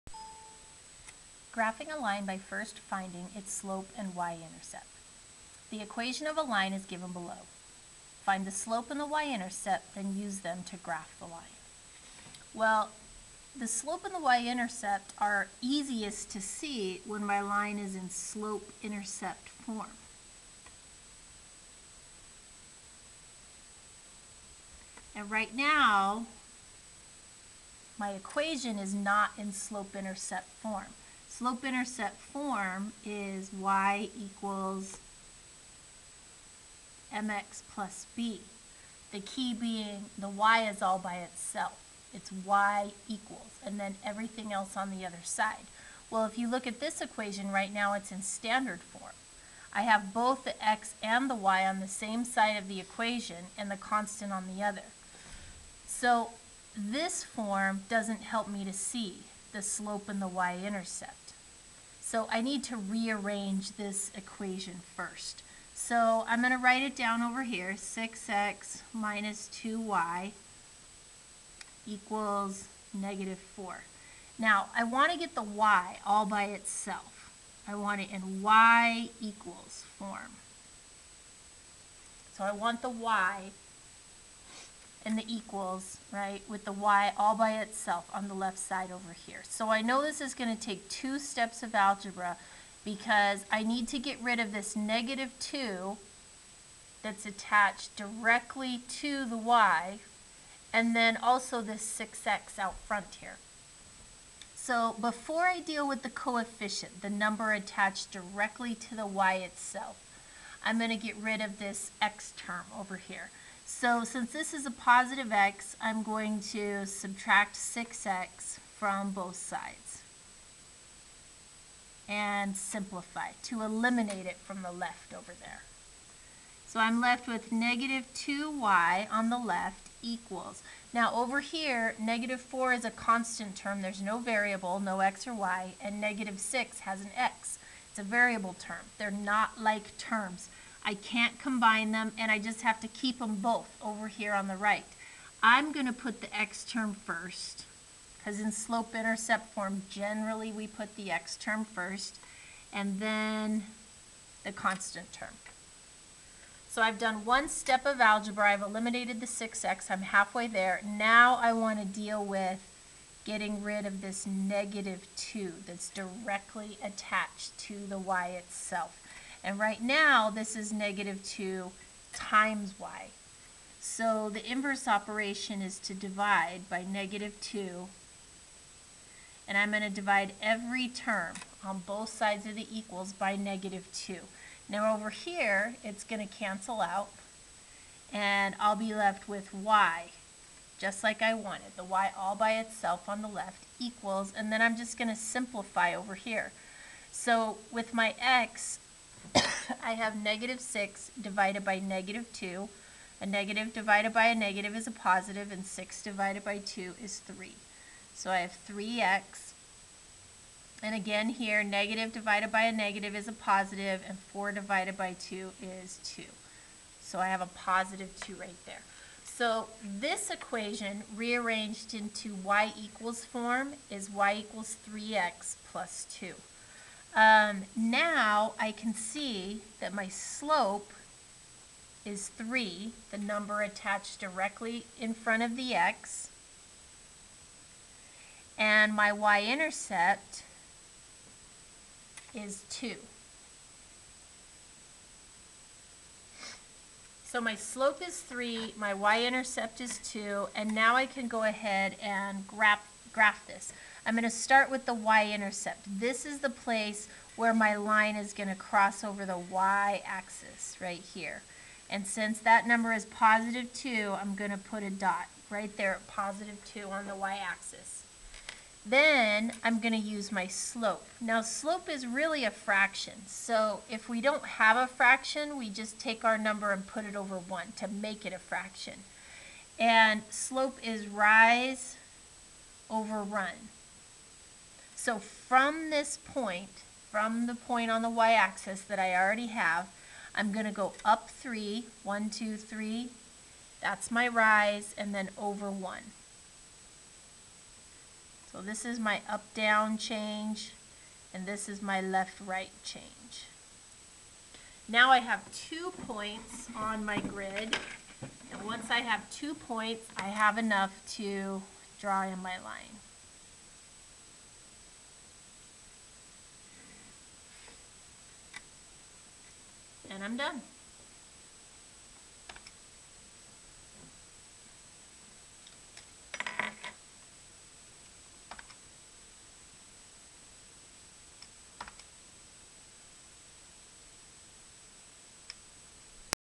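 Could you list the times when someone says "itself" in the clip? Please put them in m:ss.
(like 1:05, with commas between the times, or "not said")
0:41, 1:16, 1:27, 1:49, 2:48, 3:12.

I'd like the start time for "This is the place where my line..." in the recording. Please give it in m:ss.
4:15.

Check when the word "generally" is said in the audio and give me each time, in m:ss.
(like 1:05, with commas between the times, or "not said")
2:29.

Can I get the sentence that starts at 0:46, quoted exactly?
Well, if you look at this equation right now, it's in standard form.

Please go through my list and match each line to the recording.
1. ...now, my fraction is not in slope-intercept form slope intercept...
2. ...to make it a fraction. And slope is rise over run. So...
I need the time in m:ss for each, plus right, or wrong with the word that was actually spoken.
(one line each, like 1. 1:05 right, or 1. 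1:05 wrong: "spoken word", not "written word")
1. 0:25 wrong: "equation", not "fraction"
2. 4:37 right.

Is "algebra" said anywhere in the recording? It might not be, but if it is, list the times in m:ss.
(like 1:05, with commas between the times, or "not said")
1:31, 2:37.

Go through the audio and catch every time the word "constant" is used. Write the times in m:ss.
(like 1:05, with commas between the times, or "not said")
0:53, 2:12, 2:34.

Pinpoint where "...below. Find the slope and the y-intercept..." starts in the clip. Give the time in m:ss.
0:07.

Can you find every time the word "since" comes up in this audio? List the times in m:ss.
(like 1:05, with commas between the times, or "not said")
1:54, 4:22.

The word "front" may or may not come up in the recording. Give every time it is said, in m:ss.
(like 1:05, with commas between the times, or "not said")
1:42, 3:55.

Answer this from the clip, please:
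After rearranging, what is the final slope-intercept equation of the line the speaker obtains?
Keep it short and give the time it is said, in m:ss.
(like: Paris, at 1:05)
y = 3x + 2, at 3:44.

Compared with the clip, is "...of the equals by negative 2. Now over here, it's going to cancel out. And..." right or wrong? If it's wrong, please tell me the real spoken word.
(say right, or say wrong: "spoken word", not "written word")
right.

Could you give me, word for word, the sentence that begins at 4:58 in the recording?
So this is my up-down change, and this is my left-right change.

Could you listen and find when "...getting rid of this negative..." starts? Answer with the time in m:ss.
2:43.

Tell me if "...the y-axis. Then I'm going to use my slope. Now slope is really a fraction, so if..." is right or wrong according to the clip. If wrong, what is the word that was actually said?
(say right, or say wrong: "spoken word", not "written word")
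right.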